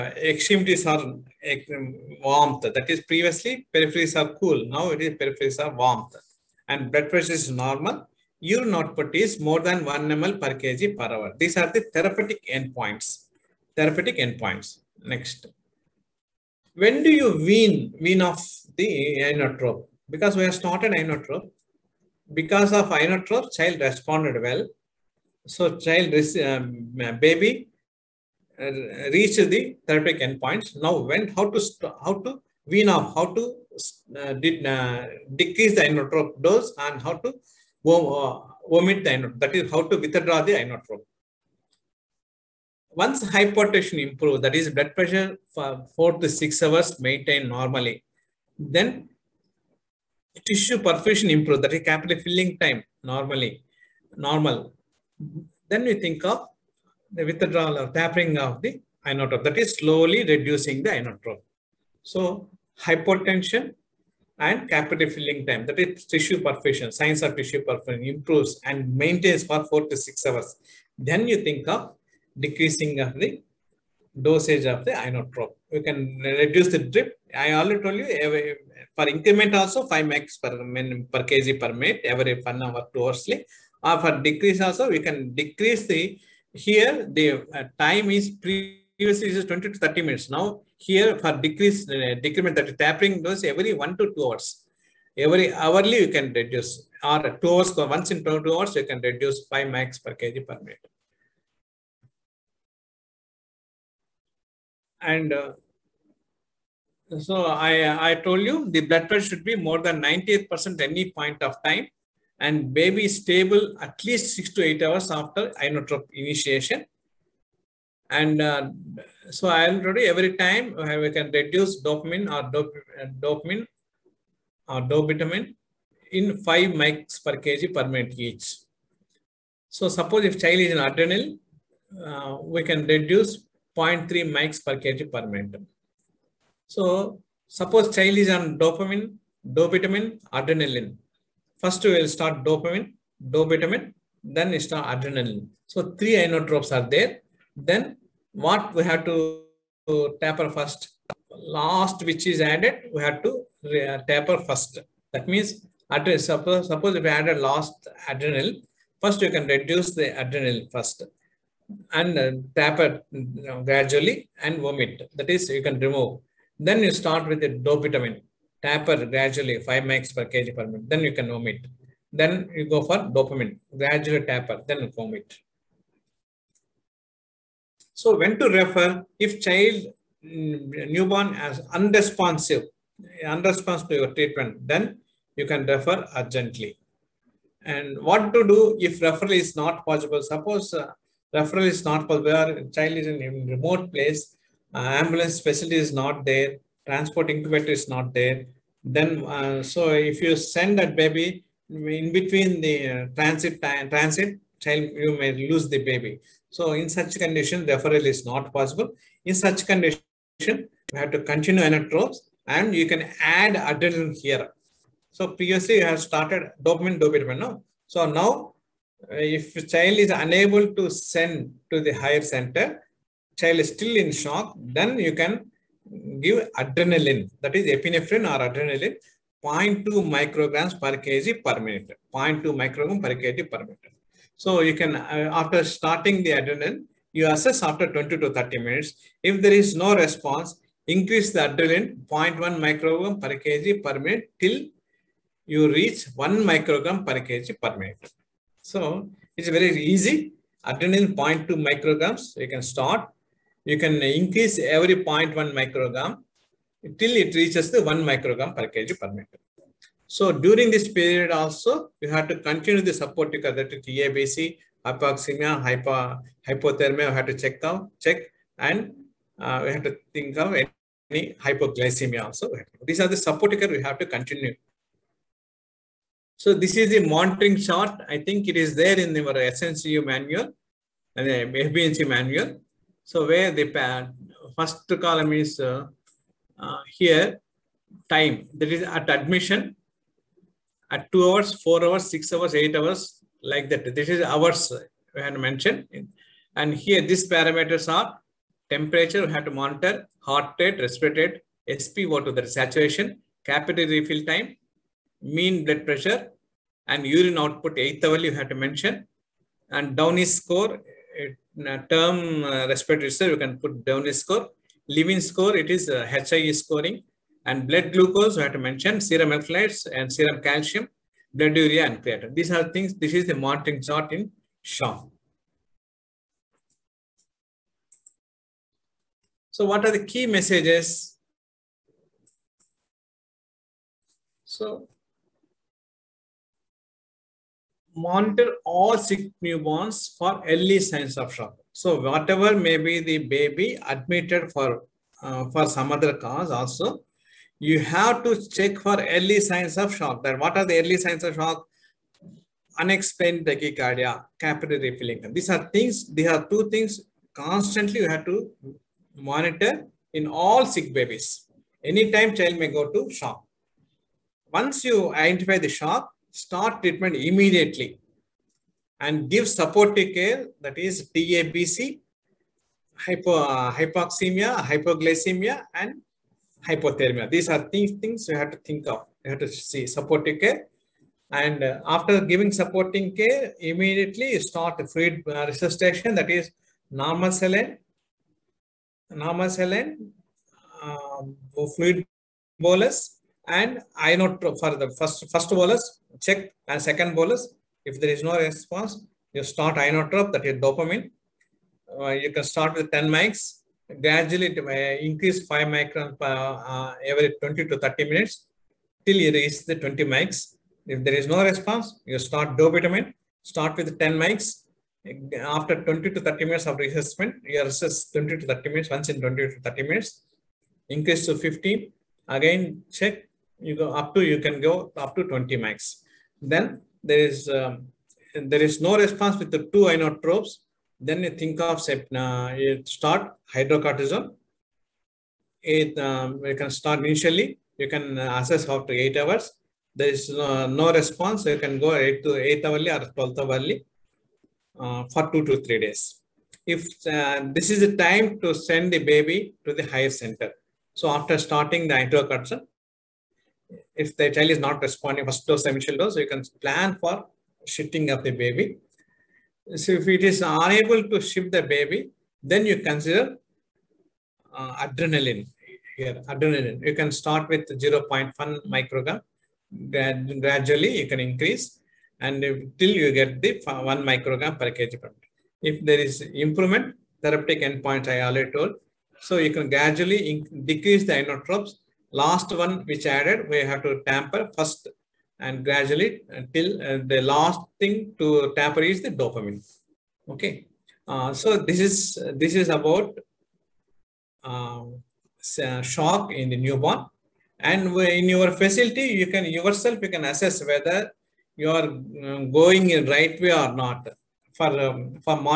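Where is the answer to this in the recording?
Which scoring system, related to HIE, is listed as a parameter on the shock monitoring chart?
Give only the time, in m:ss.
5:14.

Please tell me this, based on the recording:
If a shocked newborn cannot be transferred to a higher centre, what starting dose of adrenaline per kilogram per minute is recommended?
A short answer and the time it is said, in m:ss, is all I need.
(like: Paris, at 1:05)
0.2 micrograms, at 3:49.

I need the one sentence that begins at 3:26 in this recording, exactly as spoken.
So in such condition, referral is not possible.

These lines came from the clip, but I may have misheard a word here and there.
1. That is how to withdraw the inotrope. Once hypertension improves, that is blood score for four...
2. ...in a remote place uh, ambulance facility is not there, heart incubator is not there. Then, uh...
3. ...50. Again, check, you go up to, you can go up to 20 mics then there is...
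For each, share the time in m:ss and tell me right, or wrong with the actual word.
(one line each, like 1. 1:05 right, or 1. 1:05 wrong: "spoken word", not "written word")
1. 0:39 wrong: "pressure", not "score"
2. 3:13 wrong: "transport", not "heart"
3. 7:01 right.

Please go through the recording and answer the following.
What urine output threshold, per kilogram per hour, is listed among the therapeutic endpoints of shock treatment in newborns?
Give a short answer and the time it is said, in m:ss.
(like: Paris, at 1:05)
more than 1 ml, at 0:09.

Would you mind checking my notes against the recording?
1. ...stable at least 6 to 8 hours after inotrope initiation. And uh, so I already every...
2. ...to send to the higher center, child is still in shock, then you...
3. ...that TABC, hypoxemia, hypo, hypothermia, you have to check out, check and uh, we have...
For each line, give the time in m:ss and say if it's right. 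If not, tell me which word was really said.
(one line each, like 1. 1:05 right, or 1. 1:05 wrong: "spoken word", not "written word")
1. 1:53 right
2. 3:40 right
3. 4:23 right.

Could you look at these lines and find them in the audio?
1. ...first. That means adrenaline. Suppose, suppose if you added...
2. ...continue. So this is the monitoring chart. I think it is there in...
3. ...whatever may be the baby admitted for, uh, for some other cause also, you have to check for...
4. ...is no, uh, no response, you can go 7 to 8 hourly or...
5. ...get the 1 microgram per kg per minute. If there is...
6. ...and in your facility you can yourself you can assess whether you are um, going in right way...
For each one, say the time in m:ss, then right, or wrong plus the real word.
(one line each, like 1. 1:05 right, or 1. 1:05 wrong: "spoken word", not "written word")
1. 2:34 right
2. 4:34 right
3. 5:42 right
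4. 7:20 wrong: "8", not "7"
5. 7:53 right
6. 8:17 right.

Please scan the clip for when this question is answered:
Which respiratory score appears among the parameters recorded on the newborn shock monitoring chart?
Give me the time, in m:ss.
5:09.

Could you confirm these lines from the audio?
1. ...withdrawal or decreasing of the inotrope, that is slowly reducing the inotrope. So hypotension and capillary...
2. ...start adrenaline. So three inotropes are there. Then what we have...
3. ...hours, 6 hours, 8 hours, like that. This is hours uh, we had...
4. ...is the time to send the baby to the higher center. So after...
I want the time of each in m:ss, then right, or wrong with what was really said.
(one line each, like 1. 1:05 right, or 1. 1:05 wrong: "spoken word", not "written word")
1. 0:57 wrong: "tapering", not "decreasing"
2. 2:24 right
3. 4:51 right
4. 7:27 right.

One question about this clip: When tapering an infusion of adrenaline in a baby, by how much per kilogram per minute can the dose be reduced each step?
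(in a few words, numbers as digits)
0.3 mics.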